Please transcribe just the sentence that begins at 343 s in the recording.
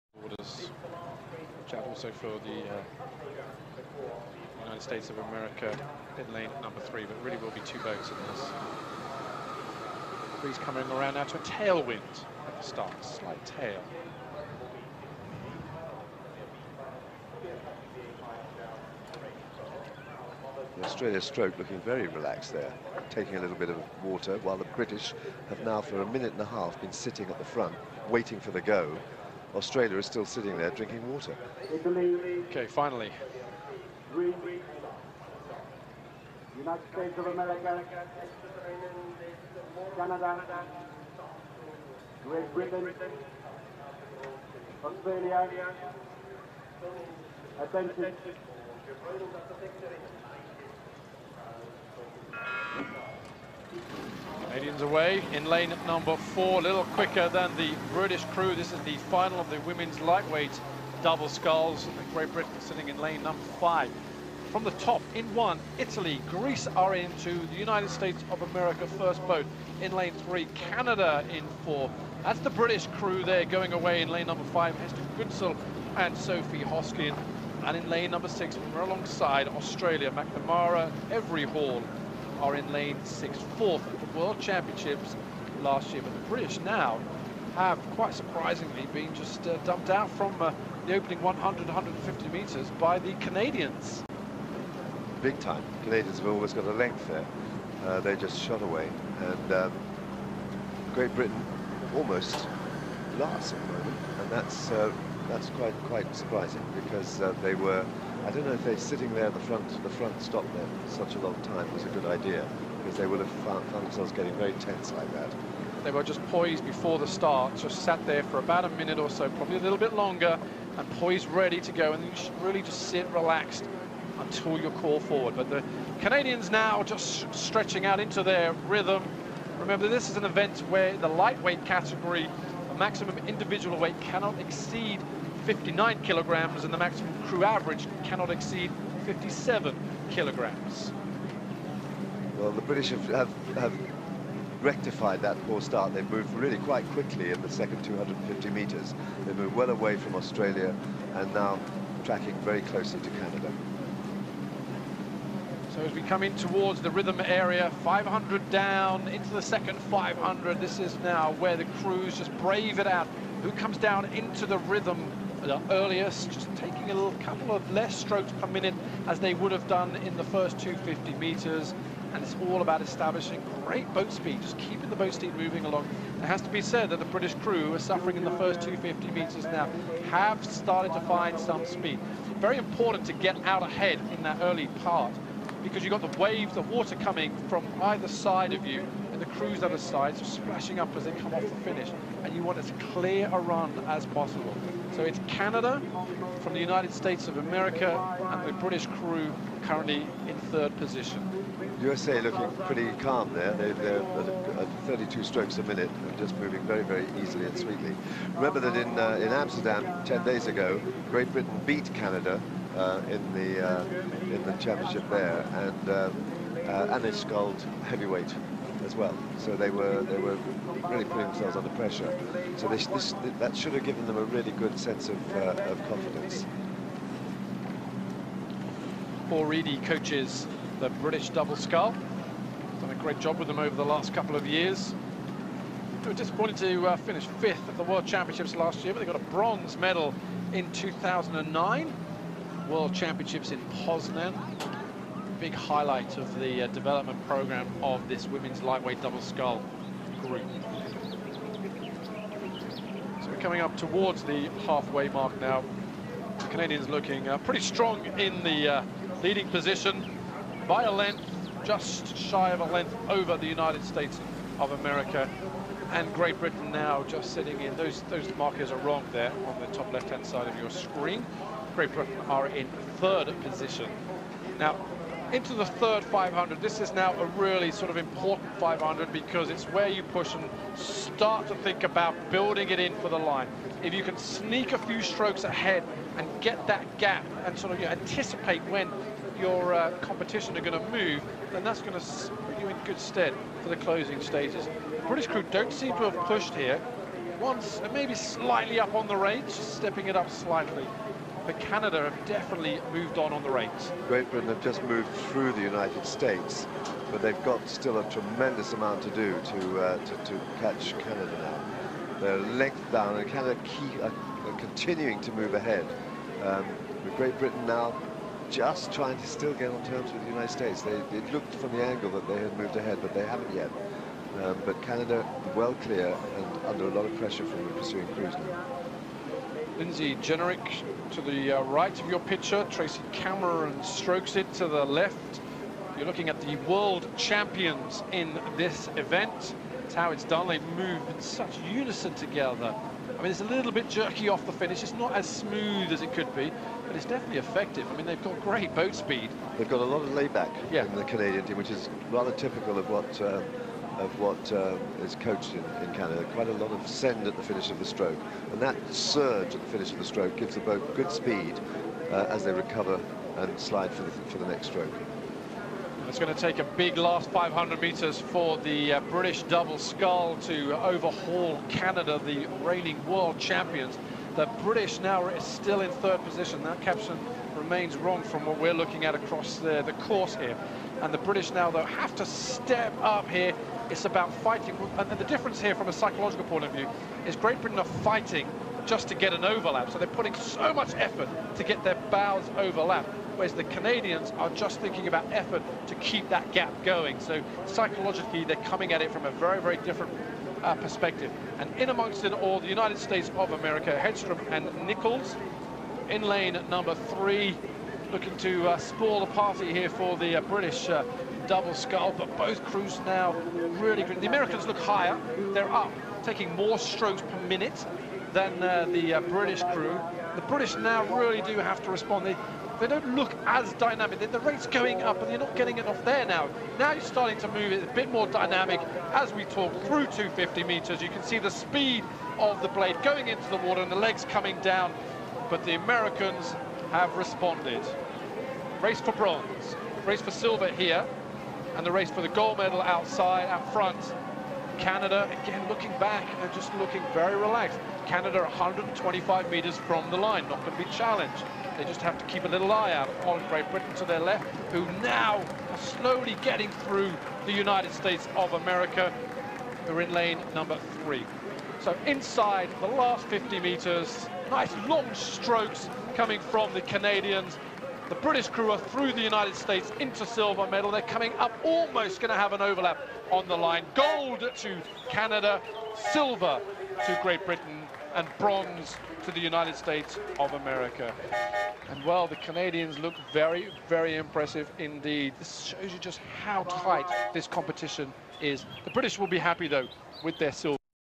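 I mean, it's a little bit jerky off the finish.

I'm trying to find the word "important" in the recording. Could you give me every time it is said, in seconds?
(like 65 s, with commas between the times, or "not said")
182 s, 277 s.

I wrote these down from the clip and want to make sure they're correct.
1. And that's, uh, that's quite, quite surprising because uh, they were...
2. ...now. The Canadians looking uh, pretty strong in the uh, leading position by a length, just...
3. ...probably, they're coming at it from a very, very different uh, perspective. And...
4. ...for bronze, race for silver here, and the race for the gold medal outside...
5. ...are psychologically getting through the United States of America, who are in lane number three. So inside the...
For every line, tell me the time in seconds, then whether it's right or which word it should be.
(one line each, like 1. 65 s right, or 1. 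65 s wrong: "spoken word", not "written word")
1. 104 s right
2. 255 s right
3. 397 s wrong: "psychologically", not "probably"
4. 438 s right
5. 455 s wrong: "slowly", not "psychologically".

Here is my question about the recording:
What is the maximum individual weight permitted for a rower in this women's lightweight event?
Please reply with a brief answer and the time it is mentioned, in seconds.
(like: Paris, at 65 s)
59 kilograms, at 135 s.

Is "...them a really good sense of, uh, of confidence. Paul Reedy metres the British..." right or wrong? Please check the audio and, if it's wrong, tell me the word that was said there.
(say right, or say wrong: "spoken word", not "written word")
wrong: "coaches", not "metres".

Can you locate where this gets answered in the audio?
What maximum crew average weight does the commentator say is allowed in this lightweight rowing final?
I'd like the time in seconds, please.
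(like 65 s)
139 s.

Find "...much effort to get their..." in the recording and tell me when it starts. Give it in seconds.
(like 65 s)
390 s.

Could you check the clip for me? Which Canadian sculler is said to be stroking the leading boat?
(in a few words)
Tracy Cameron.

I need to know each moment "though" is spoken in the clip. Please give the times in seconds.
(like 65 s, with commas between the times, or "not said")
381 s, 489 s.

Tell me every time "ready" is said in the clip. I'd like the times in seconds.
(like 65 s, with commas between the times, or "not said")
121 s.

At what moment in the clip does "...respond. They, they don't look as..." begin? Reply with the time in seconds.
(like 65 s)
421 s.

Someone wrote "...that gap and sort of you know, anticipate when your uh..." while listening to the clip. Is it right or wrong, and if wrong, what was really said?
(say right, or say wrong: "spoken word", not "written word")
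right.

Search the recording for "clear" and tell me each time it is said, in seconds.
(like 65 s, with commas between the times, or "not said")
192 s, 325 s.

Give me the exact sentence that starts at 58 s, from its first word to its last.
This is the final of the women's lightweight double sculls.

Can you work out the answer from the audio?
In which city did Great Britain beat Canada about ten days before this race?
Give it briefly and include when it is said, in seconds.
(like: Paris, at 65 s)
Amsterdam, at 209 s.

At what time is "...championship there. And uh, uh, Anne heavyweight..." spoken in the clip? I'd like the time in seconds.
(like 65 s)
214 s.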